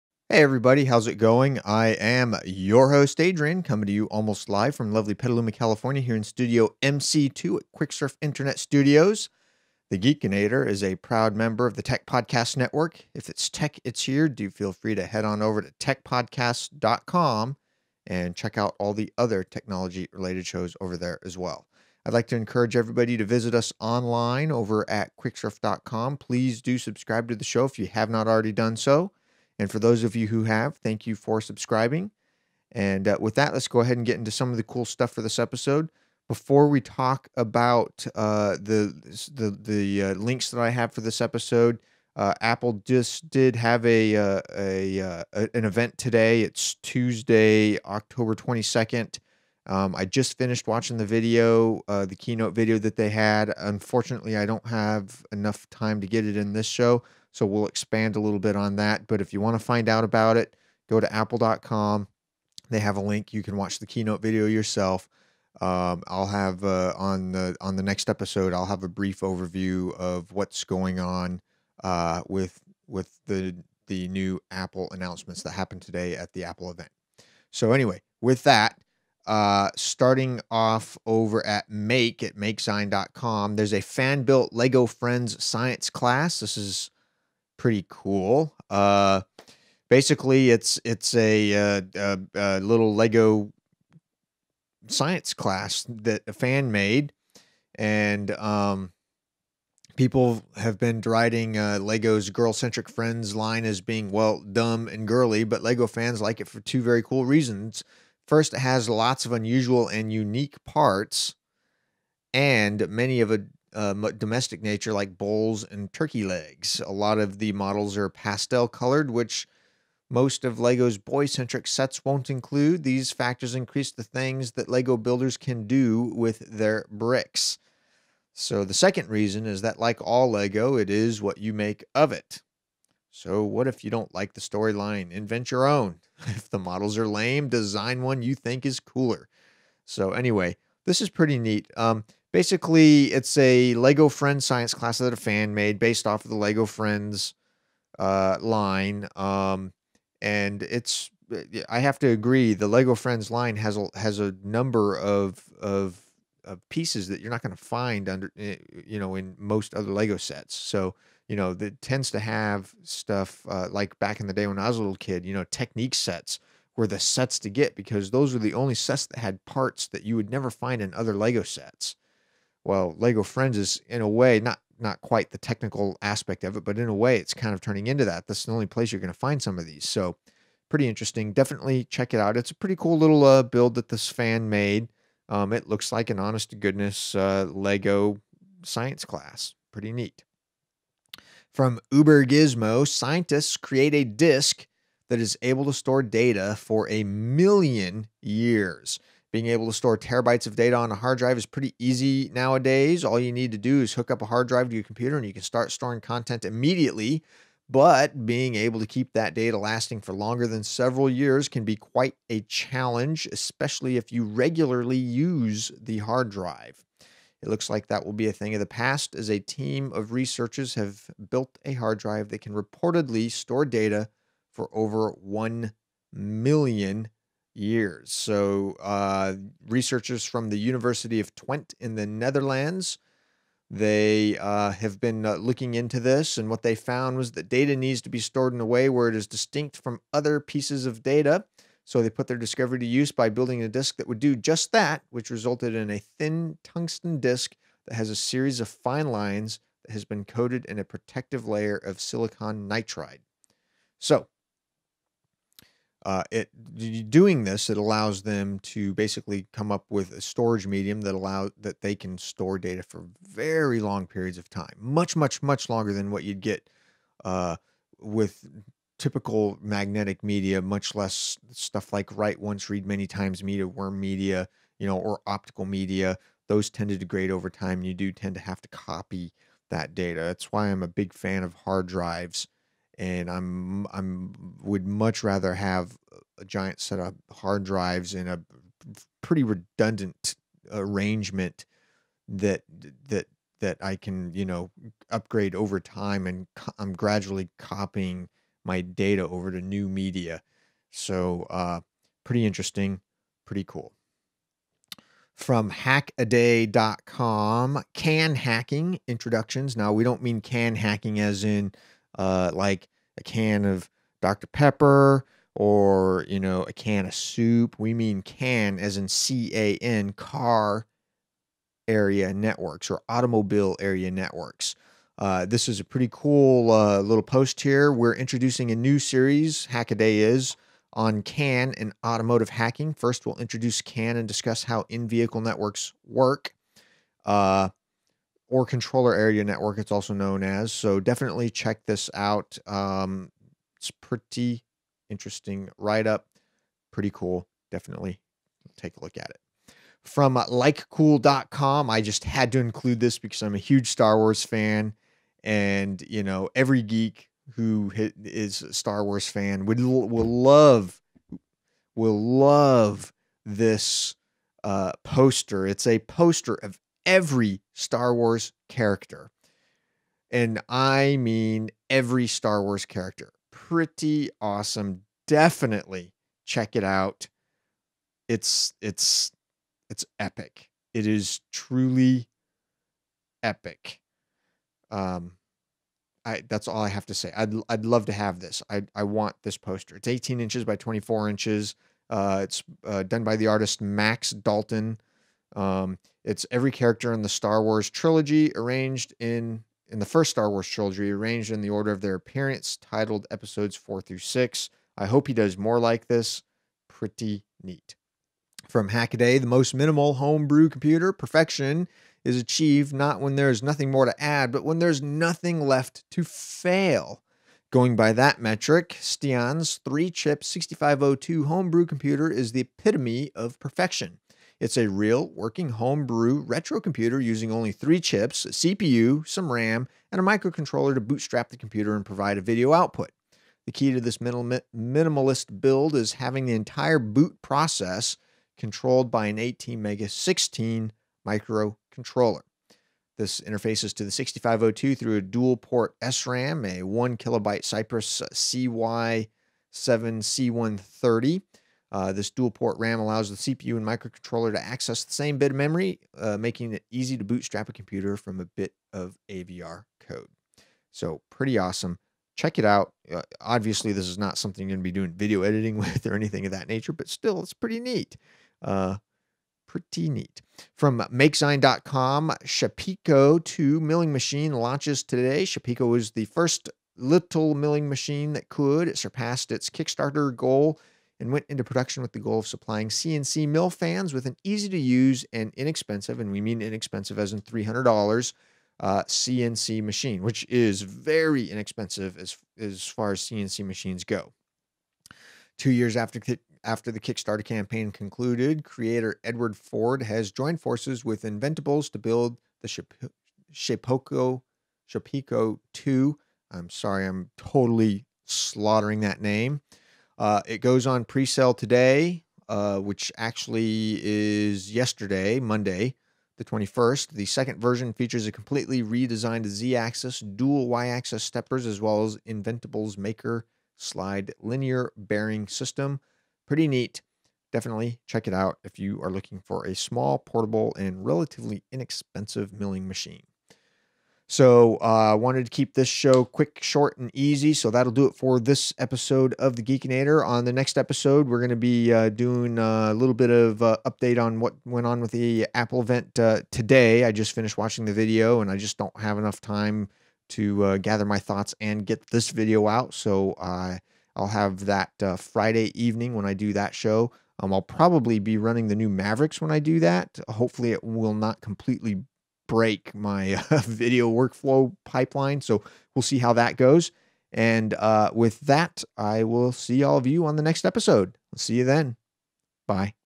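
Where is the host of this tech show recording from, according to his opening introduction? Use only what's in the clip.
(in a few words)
Petaluma, California.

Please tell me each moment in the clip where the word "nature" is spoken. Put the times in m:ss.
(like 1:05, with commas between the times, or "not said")
1:54, 7:46.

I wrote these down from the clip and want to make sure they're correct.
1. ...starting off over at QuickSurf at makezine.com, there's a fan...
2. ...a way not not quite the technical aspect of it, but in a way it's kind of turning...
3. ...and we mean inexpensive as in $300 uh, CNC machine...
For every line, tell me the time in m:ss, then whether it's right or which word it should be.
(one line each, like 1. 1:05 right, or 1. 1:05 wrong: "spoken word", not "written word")
1. 1:19 wrong: "Make", not "QuickSurf"
2. 2:54 right
3. 8:06 right.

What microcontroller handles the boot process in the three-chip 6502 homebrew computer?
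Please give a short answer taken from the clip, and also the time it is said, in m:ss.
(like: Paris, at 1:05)
ATmega16, at 7:19.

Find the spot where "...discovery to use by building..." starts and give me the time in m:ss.
4:02.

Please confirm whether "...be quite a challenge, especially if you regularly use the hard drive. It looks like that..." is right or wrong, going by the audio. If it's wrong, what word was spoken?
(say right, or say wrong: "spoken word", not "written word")
right.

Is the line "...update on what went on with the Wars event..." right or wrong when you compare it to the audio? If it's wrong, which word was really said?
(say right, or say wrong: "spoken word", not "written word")
wrong: "Apple", not "Wars".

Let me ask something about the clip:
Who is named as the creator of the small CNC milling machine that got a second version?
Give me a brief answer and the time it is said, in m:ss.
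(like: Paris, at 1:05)
Edward Ford, at 8:19.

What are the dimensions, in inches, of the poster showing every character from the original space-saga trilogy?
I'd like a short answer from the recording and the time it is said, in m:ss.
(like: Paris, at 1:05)
18 by 24 inches, at 6:30.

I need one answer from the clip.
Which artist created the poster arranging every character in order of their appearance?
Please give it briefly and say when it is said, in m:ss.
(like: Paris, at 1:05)
Max Dalton, at 6:33.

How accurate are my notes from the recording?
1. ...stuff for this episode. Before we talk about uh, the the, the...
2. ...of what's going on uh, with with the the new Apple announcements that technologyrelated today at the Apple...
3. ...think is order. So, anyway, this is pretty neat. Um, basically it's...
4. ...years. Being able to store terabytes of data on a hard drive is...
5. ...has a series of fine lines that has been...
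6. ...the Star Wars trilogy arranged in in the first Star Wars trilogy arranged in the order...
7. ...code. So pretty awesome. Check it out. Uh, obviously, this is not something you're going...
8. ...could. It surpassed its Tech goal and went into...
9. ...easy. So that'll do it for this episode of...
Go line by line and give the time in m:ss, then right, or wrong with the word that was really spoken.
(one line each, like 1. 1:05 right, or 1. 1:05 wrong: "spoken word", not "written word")
1. 0:34 right
2. 1:09 wrong: "happened", not "technologyrelated"
3. 2:18 wrong: "cooler", not "order"
4. 3:18 right
5. 4:07 right
6. 6:37 right
7. 7:39 right
8. 7:58 wrong: "Kickstarter", not "Tech"
9. 8:57 right.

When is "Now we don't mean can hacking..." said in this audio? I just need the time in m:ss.
5:09.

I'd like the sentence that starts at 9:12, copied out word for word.
So uh, I'll have that Friday evening when I do that show.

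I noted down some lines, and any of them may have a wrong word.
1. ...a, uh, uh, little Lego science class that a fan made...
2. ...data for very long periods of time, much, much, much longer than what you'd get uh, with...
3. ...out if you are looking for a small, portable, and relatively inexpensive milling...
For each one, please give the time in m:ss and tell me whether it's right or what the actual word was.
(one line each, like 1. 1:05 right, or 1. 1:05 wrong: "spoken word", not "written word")
1. 1:31 right
2. 4:22 right
3. 8:48 right.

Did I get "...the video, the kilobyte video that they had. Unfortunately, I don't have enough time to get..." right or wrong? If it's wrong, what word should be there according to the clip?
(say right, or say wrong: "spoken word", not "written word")
wrong: "keynote", not "kilobyte".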